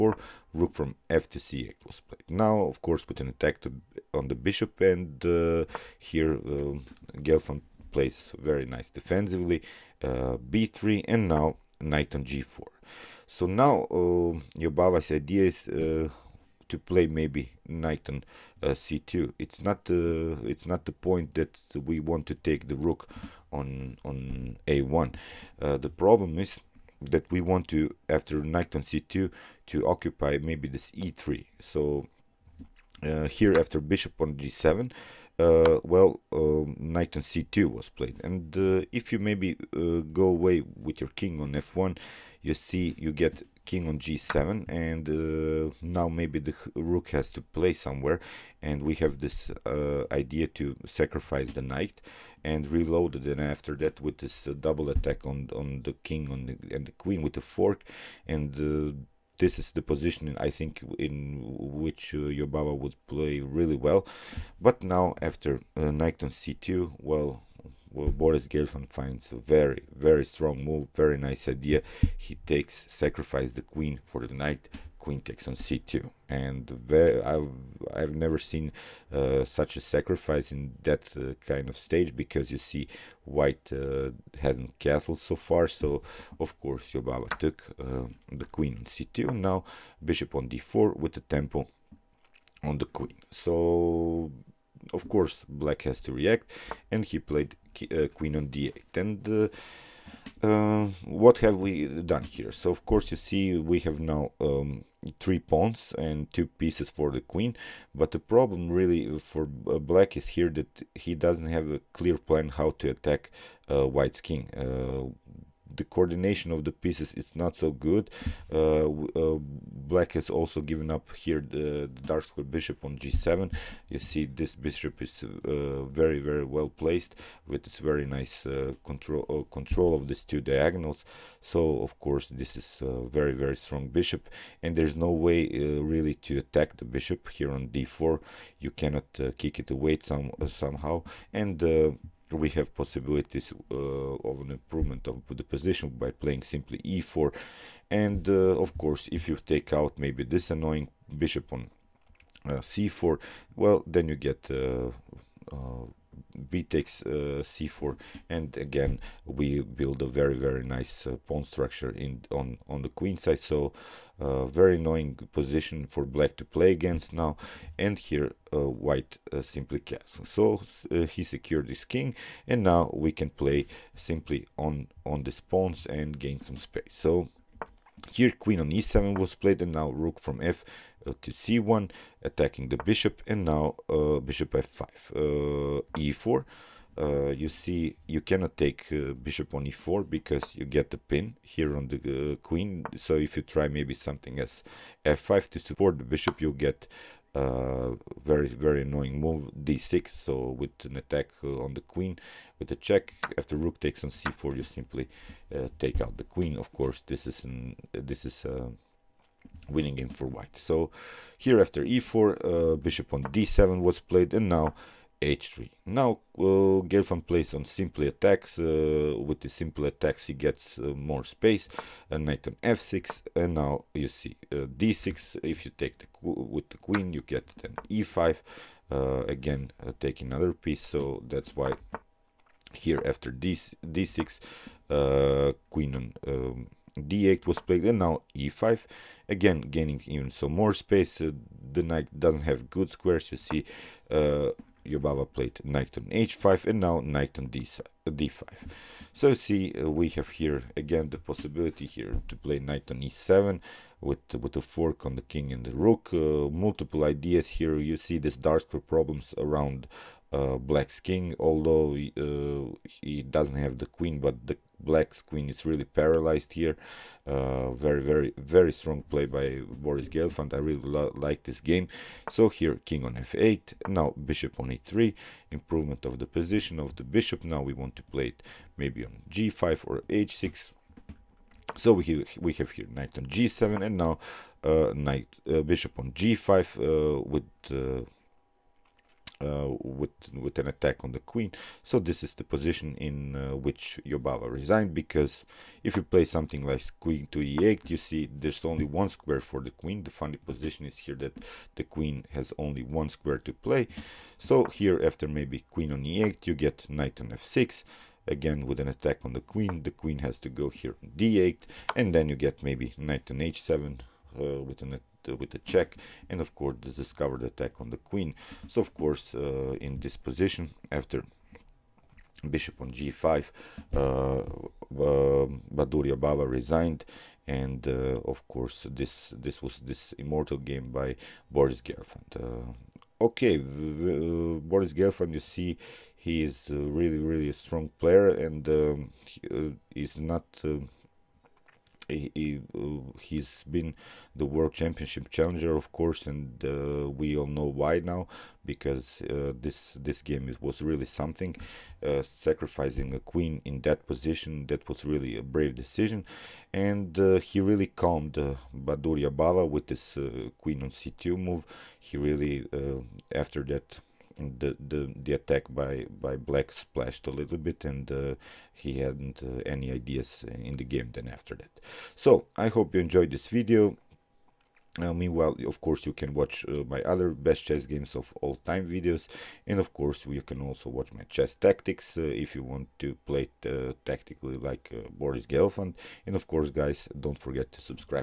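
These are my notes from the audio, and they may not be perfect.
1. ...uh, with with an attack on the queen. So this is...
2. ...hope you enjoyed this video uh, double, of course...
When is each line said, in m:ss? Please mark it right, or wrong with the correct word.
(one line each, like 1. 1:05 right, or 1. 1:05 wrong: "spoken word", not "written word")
1. 4:49 right
2. 6:12 wrong: "meanwhile", not "double".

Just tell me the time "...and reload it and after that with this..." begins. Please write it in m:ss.
0:52.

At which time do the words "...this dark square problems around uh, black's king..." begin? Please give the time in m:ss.
4:18.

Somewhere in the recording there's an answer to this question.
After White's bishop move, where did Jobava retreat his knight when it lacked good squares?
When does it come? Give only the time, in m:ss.
4:05.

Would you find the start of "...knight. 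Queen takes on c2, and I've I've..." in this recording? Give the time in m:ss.
1:14.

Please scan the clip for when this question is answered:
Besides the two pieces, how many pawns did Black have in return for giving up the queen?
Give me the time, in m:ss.
1:45.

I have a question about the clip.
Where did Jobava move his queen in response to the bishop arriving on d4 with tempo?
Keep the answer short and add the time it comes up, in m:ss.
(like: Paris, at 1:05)
d8, at 1:38.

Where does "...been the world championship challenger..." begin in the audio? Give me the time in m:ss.
5:43.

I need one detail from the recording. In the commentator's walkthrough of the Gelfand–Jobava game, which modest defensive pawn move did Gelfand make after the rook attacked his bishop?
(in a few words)
b3.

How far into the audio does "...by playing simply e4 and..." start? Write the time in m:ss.
2:25.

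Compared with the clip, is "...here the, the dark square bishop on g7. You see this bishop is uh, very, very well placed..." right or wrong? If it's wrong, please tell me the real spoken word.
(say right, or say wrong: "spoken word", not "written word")
right.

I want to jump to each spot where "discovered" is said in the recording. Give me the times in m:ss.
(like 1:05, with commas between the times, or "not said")
5:16.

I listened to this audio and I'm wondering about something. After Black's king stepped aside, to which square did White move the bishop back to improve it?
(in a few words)
e3.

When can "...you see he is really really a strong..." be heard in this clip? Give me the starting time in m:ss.
5:35.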